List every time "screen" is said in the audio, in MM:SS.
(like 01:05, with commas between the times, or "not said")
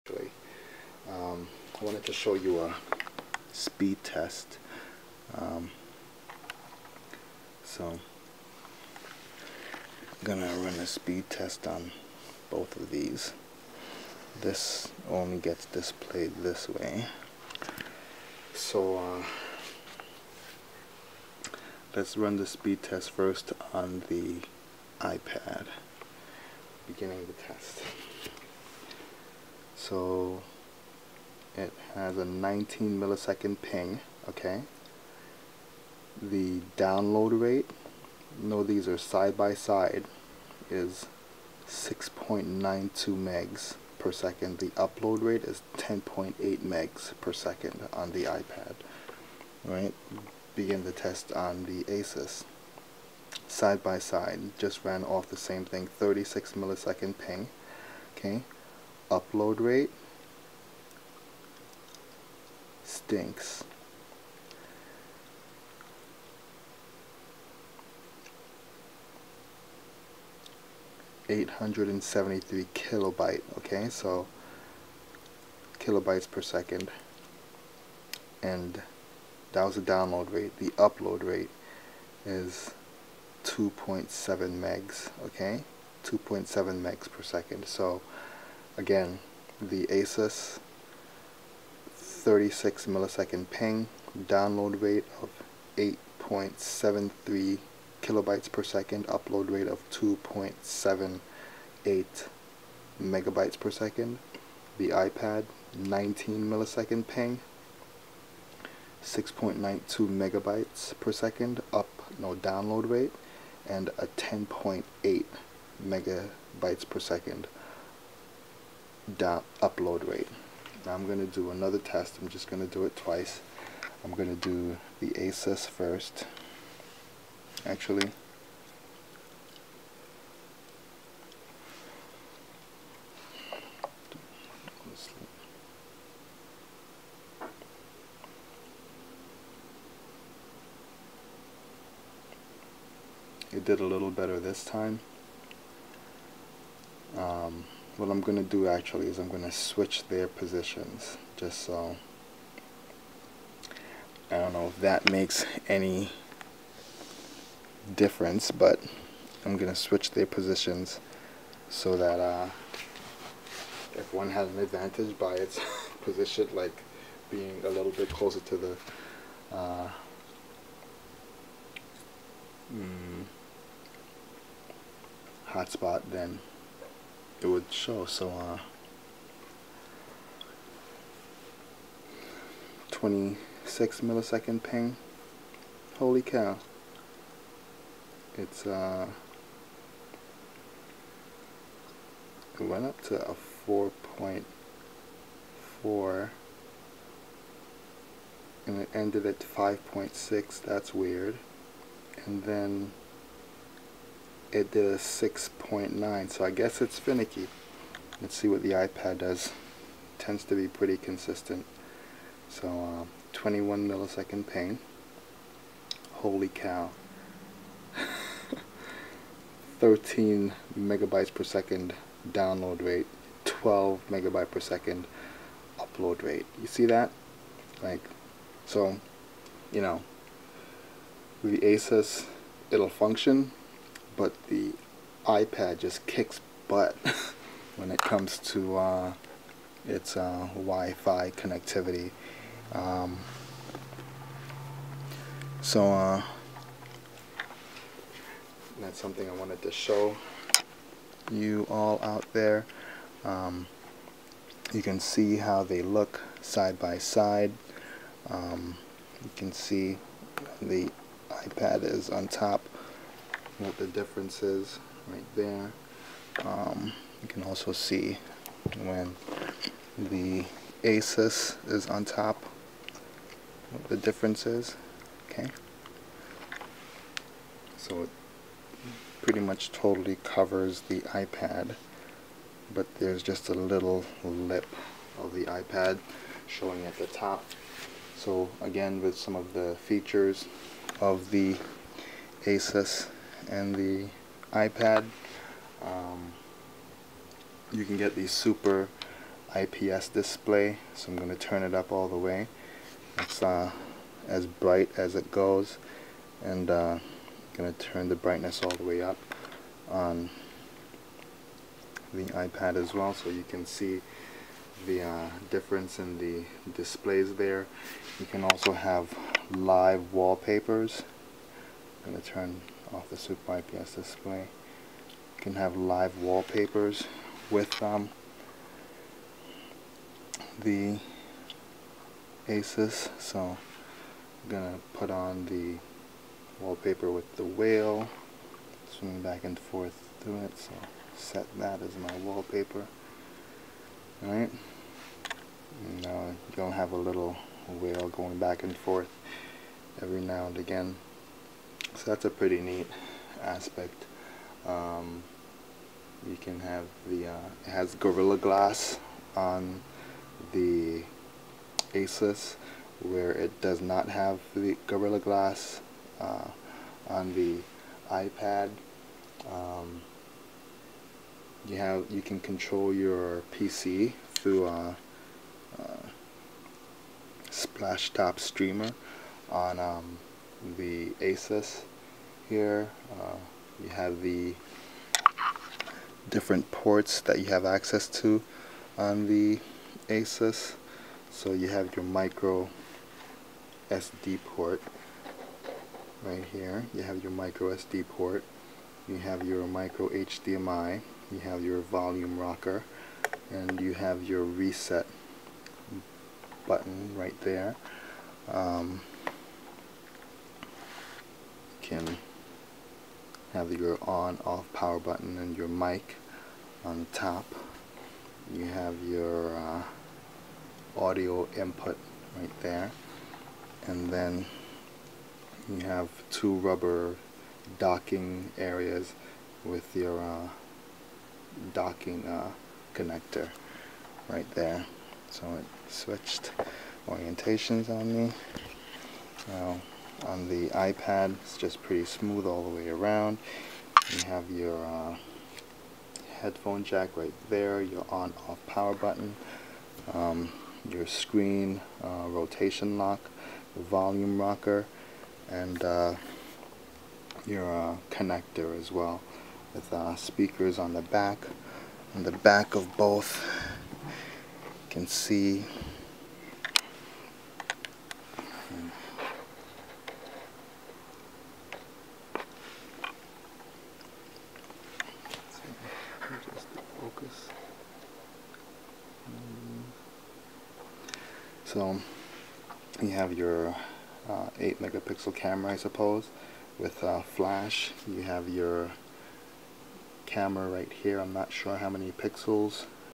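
07:31.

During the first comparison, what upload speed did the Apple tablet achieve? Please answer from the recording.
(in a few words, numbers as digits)
10.8 megs per second.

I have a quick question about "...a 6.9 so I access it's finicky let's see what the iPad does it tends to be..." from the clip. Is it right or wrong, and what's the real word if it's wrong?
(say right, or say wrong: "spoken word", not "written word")
wrong: "guess", not "access".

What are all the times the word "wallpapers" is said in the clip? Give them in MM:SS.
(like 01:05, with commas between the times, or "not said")
05:20, 05:26, 05:36, 05:42.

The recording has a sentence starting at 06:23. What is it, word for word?
Uh, you have the different ports that you have access to on the ASUS.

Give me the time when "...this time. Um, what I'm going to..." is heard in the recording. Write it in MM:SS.
02:24.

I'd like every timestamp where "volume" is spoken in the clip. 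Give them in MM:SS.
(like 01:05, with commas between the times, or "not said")
06:41, 07:33.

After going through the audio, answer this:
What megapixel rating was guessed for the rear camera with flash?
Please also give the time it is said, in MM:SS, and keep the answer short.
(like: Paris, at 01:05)
8 megapixel, at 08:04.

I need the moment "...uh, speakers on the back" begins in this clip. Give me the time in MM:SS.
07:39.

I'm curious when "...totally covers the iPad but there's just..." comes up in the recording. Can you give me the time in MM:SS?
04:39.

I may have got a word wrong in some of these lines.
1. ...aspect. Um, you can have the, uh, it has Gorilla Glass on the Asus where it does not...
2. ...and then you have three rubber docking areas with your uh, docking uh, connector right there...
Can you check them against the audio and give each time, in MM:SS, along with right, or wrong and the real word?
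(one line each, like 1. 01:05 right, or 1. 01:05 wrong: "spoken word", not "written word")
1. 05:53 right
2. 07:03 wrong: "two", not "three".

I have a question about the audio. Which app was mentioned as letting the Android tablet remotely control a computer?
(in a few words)
Splashtop Streamer.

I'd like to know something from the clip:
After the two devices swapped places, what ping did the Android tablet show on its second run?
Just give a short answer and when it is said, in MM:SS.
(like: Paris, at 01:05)
26 milliseconds, at 03:02.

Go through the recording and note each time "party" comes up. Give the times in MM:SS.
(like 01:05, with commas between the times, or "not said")
not said.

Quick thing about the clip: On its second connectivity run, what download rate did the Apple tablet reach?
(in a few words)
13 megabytes per second.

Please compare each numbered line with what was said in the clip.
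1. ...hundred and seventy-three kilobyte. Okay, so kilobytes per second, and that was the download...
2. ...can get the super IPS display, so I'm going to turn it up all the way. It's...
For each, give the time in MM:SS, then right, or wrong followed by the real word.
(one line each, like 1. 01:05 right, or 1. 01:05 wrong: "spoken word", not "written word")
1. 01:11 right
2. 04:57 right.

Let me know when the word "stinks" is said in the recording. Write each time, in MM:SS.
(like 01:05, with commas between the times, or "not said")
01:03.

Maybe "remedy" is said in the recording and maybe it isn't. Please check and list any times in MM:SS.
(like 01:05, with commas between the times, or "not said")
not said.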